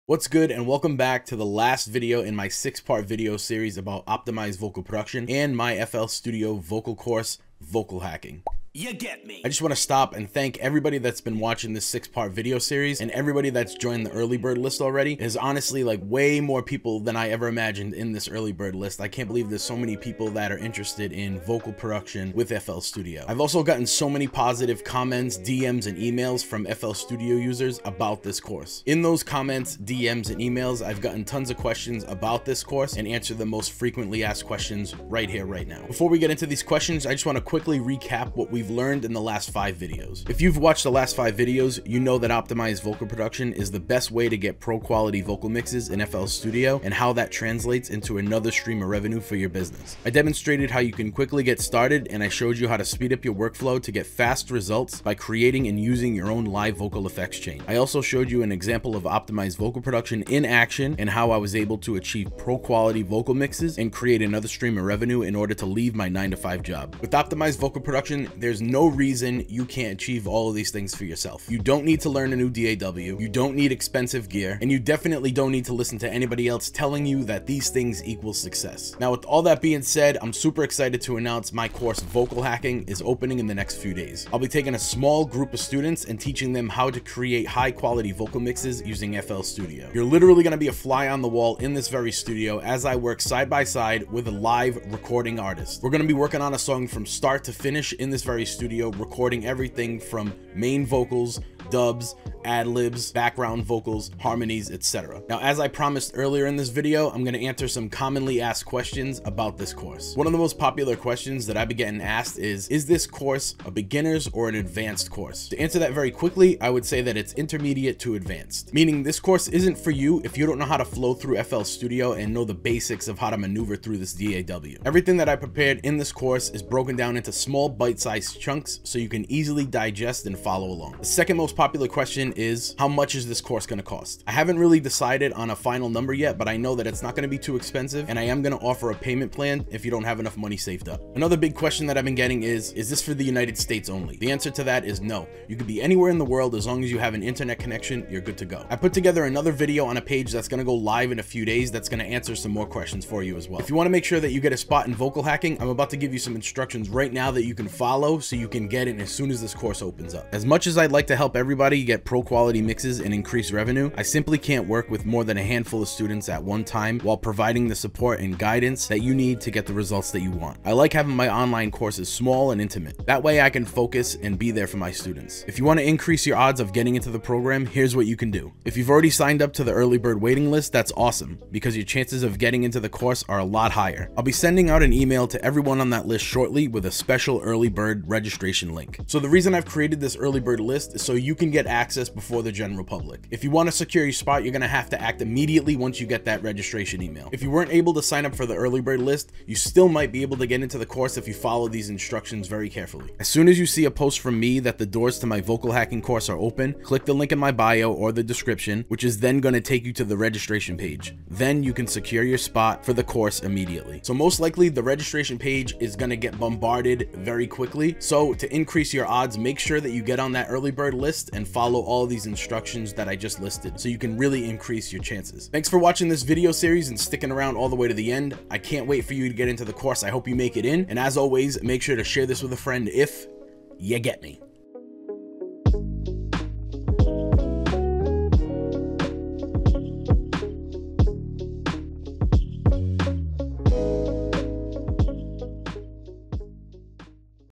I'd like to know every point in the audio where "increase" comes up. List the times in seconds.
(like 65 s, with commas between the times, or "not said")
163 s, 175 s, 218 s, 224 s.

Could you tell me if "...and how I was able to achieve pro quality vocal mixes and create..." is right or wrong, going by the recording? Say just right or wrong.
right.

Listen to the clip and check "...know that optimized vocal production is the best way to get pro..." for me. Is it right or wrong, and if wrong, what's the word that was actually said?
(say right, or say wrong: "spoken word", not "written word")
right.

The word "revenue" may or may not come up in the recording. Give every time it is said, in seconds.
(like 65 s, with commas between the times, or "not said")
48 s, 64 s, 163 s.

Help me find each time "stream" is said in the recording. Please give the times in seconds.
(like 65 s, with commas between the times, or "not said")
48 s, 64 s.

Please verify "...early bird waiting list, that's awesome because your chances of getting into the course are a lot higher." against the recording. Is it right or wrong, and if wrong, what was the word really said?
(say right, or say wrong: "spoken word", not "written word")
right.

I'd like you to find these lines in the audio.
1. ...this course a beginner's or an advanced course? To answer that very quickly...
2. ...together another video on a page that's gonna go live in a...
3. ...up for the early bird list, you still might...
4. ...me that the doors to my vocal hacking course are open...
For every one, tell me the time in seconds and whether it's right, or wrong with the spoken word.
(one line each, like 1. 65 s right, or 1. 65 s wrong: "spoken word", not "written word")
1. 112 s right
2. 148 s right
3. 198 s right
4. 204 s right.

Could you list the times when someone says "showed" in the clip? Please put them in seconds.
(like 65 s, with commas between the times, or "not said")
52 s, 57 s.